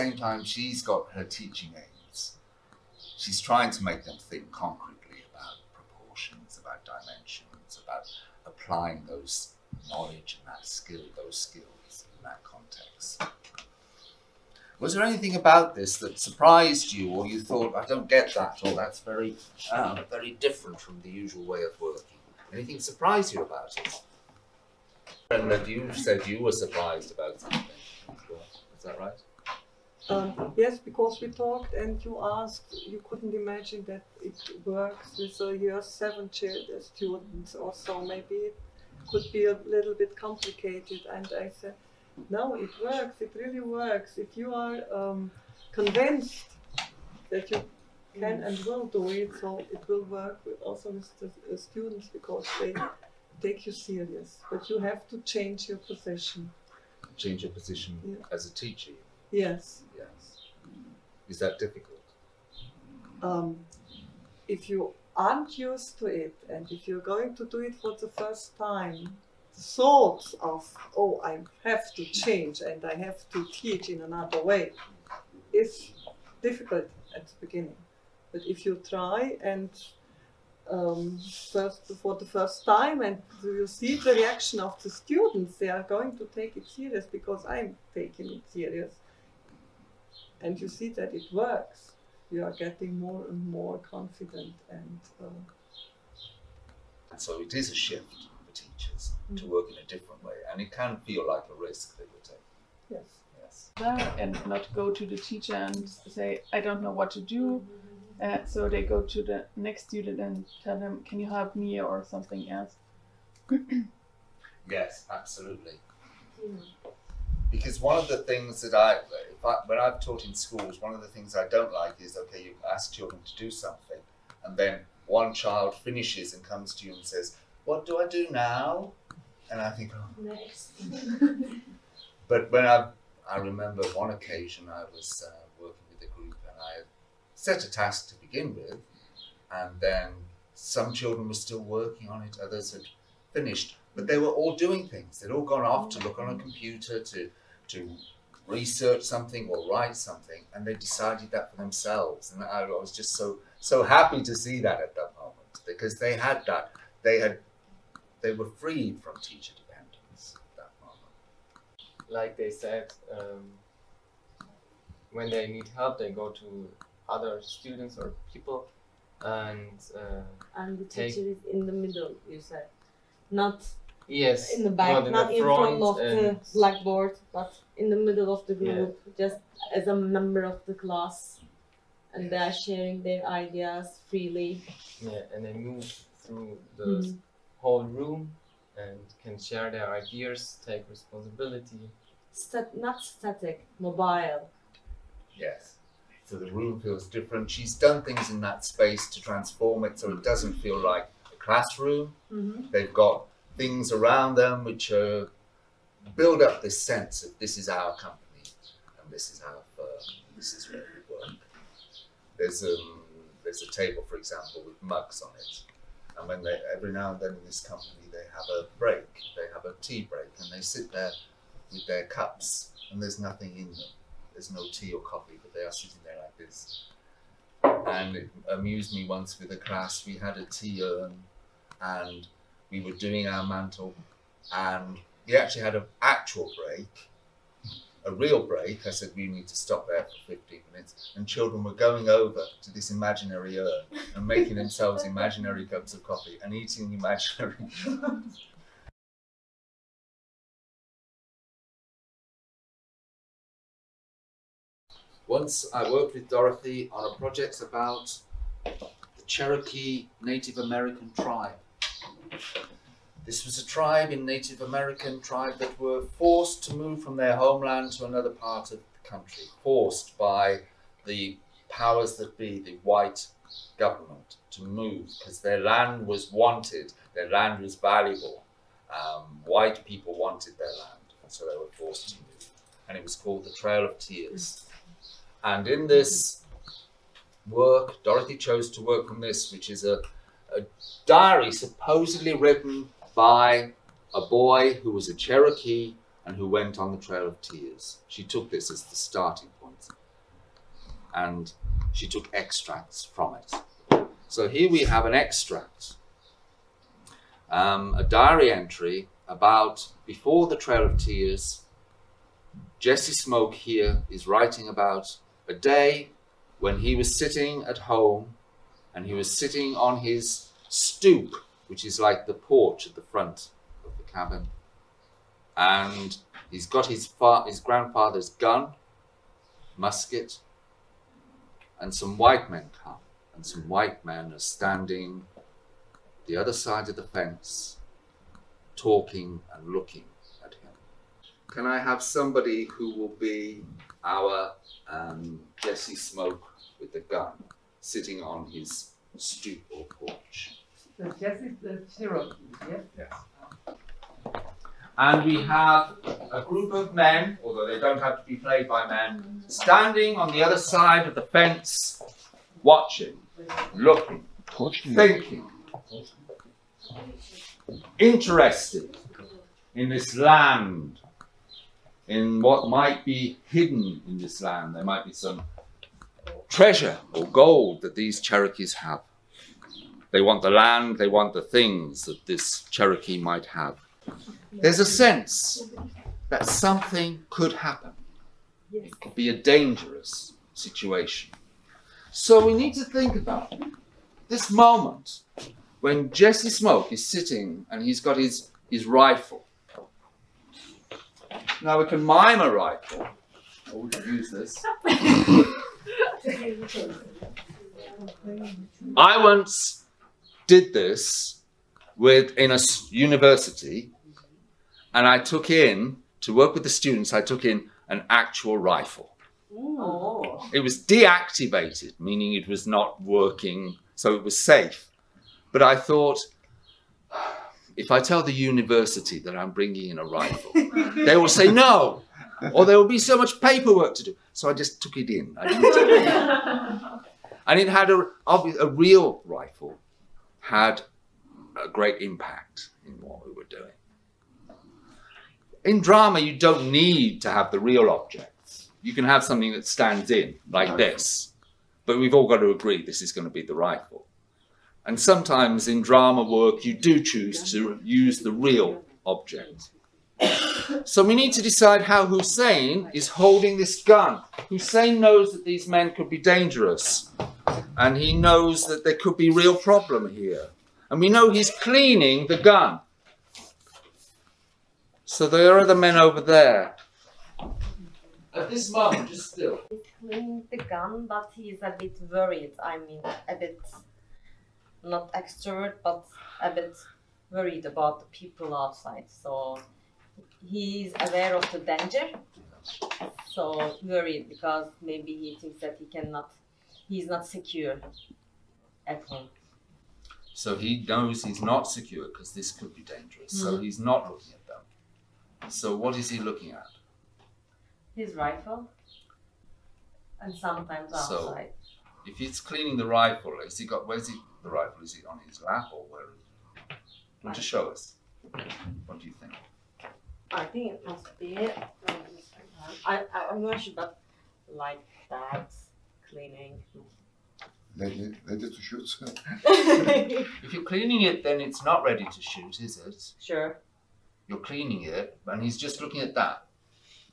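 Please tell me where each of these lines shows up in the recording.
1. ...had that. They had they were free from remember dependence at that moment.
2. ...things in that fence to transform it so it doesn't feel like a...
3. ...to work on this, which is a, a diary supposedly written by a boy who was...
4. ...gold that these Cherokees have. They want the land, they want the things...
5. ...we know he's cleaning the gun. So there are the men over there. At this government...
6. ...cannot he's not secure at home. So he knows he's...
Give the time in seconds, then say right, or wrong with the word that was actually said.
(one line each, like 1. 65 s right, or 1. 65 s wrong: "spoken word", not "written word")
1. 156 s wrong: "teacher", not "remember"
2. 198 s wrong: "space", not "fence"
3. 288 s right
4. 377 s right
5. 471 s wrong: "moment", not "government"
6. 495 s right.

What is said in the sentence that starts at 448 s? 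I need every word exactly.
You can have something that stands in, like this.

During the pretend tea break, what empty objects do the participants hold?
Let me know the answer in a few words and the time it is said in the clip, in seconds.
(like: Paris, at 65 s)
mugs, at 214 s.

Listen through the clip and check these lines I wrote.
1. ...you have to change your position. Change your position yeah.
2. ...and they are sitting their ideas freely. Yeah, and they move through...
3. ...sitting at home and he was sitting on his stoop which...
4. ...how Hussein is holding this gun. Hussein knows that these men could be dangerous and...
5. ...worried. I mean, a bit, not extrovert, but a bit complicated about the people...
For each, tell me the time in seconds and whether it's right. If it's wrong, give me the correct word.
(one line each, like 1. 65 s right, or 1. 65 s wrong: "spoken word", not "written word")
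1. 54 s right
2. 182 s wrong: "sharing", not "sitting"
3. 317 s right
4. 461 s right
5. 482 s wrong: "worried", not "complicated".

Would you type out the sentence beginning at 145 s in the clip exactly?
They'd all gone off to look on a computer to to research something or write something, and they decided that for themselves.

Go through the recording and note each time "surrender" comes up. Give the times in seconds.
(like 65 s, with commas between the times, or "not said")
not said.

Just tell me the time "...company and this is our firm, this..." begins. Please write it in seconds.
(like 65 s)
207 s.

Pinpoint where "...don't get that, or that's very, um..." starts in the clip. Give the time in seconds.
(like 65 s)
17 s.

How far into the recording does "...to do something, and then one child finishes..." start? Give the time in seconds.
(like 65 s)
123 s.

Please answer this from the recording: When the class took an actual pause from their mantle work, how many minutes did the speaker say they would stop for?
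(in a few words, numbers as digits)
15.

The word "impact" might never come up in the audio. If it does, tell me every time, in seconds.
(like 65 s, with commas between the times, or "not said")
442 s.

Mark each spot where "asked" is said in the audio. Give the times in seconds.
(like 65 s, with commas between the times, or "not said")
32 s.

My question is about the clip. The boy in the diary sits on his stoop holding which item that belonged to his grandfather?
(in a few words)
musket.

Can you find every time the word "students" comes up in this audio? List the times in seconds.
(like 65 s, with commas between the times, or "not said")
36 s, 51 s, 84 s, 109 s, 167 s, 416 s.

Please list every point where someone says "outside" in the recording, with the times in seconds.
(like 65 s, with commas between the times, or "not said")
488 s, 510 s.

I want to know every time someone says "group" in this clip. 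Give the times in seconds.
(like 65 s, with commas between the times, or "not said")
136 s, 178 s, 356 s.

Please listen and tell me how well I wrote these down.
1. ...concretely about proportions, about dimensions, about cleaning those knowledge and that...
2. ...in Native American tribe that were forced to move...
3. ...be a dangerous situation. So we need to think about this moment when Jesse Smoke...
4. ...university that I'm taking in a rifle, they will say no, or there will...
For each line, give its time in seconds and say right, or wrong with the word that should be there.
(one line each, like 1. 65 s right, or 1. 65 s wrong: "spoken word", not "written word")
1. 4 s wrong: "applying", not "cleaning"
2. 264 s right
3. 389 s right
4. 428 s wrong: "bringing", not "taking".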